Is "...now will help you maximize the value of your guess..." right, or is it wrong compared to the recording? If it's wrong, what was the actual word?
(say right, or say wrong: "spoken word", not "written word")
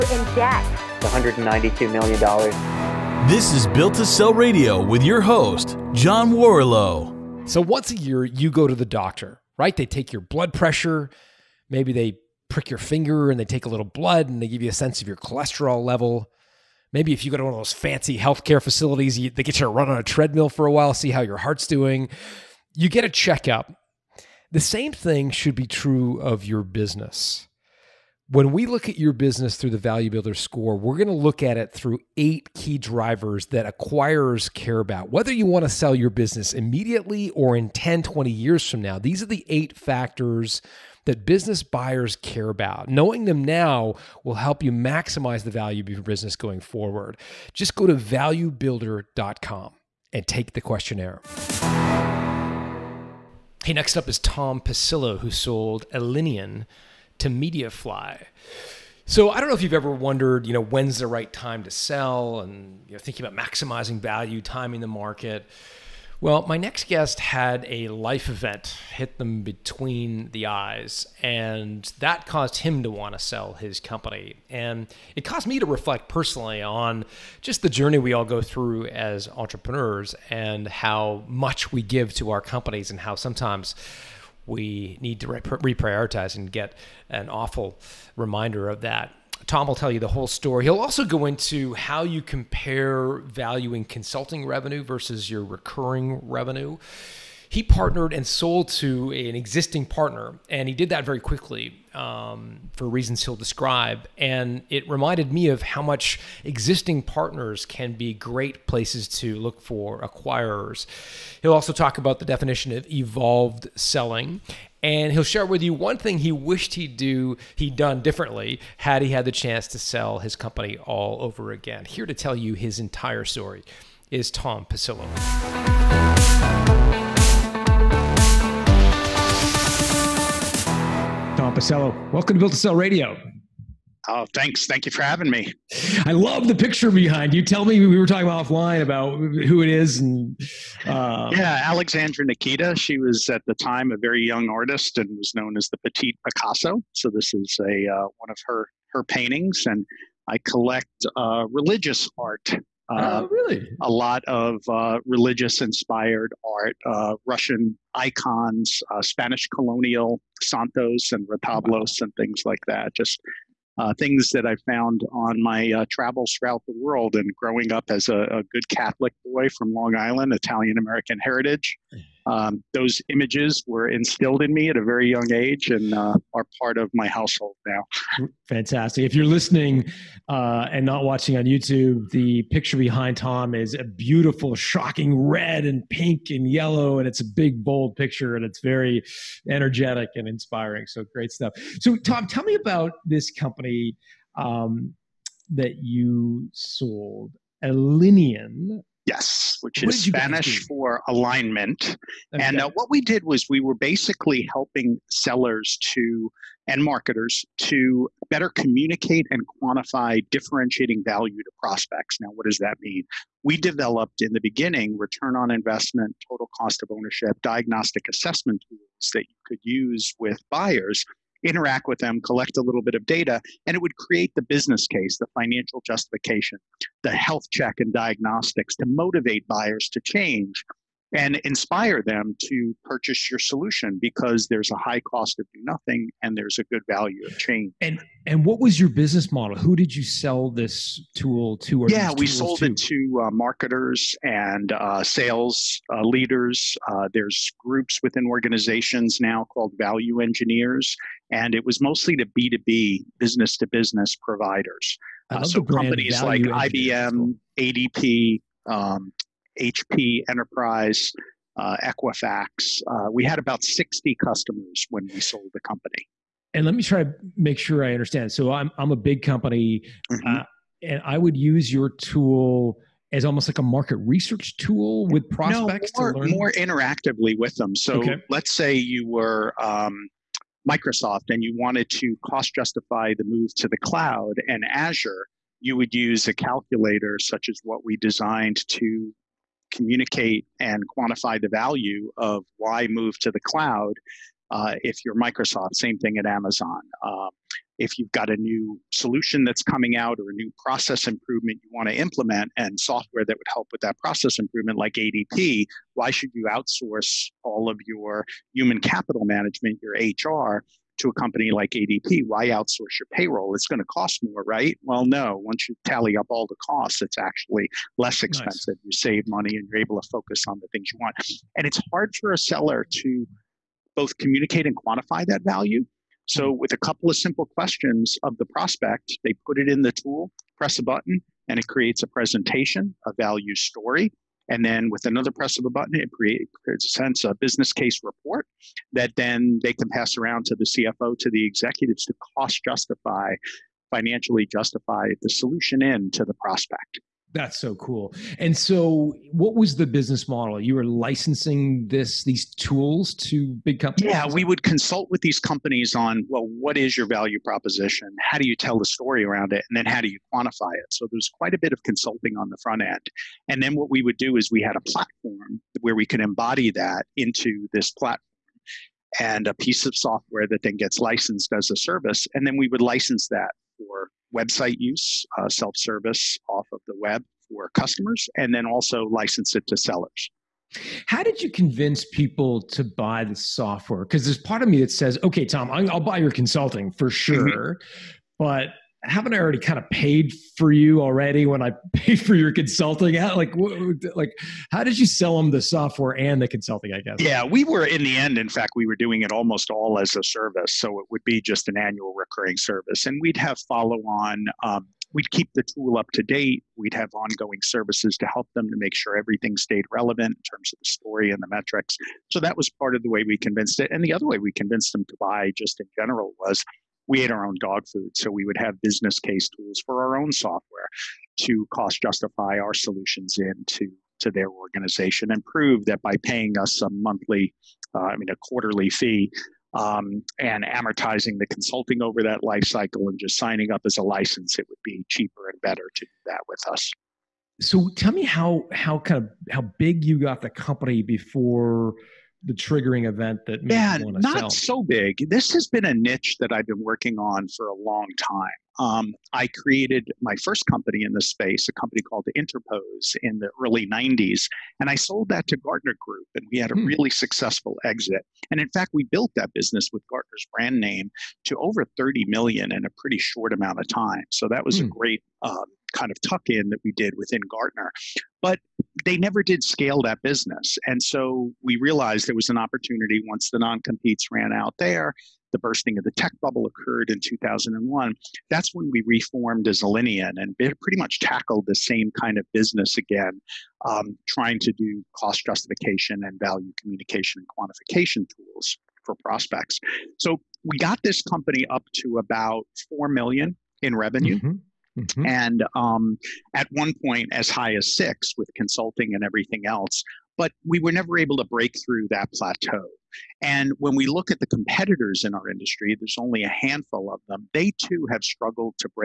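wrong: "business", not "guess".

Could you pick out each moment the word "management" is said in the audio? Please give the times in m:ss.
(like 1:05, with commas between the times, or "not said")
5:09.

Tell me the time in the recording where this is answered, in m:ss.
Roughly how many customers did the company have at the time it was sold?
4:23.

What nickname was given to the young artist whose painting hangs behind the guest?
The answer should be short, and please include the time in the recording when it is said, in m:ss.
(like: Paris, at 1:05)
the Petite Picasso, at 2:25.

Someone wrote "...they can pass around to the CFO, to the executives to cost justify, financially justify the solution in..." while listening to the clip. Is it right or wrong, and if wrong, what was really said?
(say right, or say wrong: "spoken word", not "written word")
right.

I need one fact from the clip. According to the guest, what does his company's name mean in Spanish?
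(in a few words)
alignment.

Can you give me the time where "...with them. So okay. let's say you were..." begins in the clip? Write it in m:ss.
4:37.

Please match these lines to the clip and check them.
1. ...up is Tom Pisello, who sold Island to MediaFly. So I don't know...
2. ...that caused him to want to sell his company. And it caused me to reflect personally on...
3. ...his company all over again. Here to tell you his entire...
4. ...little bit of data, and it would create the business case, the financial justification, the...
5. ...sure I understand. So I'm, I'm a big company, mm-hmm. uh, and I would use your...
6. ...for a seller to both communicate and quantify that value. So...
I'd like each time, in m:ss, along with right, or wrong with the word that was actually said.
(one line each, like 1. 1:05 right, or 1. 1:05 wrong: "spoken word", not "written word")
1. 0:53 wrong: "Alinean", not "Island"
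2. 1:11 right
3. 2:00 right
4. 3:42 right
5. 4:27 right
6. 5:22 right.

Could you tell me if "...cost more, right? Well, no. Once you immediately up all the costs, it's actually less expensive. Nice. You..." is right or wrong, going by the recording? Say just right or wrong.
wrong.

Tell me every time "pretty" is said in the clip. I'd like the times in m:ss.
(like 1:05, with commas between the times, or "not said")
7:42, 8:00.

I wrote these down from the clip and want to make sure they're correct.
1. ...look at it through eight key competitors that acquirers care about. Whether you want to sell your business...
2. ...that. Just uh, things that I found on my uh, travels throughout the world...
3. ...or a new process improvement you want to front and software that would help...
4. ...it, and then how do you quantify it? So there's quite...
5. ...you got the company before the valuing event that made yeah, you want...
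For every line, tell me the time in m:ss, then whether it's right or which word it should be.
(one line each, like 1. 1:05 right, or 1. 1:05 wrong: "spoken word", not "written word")
1. 0:31 wrong: "drivers", not "competitors"
2. 2:42 right
3. 5:00 wrong: "implement", not "front"
4. 5:59 right
5. 7:20 wrong: "triggering", not "valuing".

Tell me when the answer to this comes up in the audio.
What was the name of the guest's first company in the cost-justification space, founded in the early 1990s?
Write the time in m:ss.
7:32.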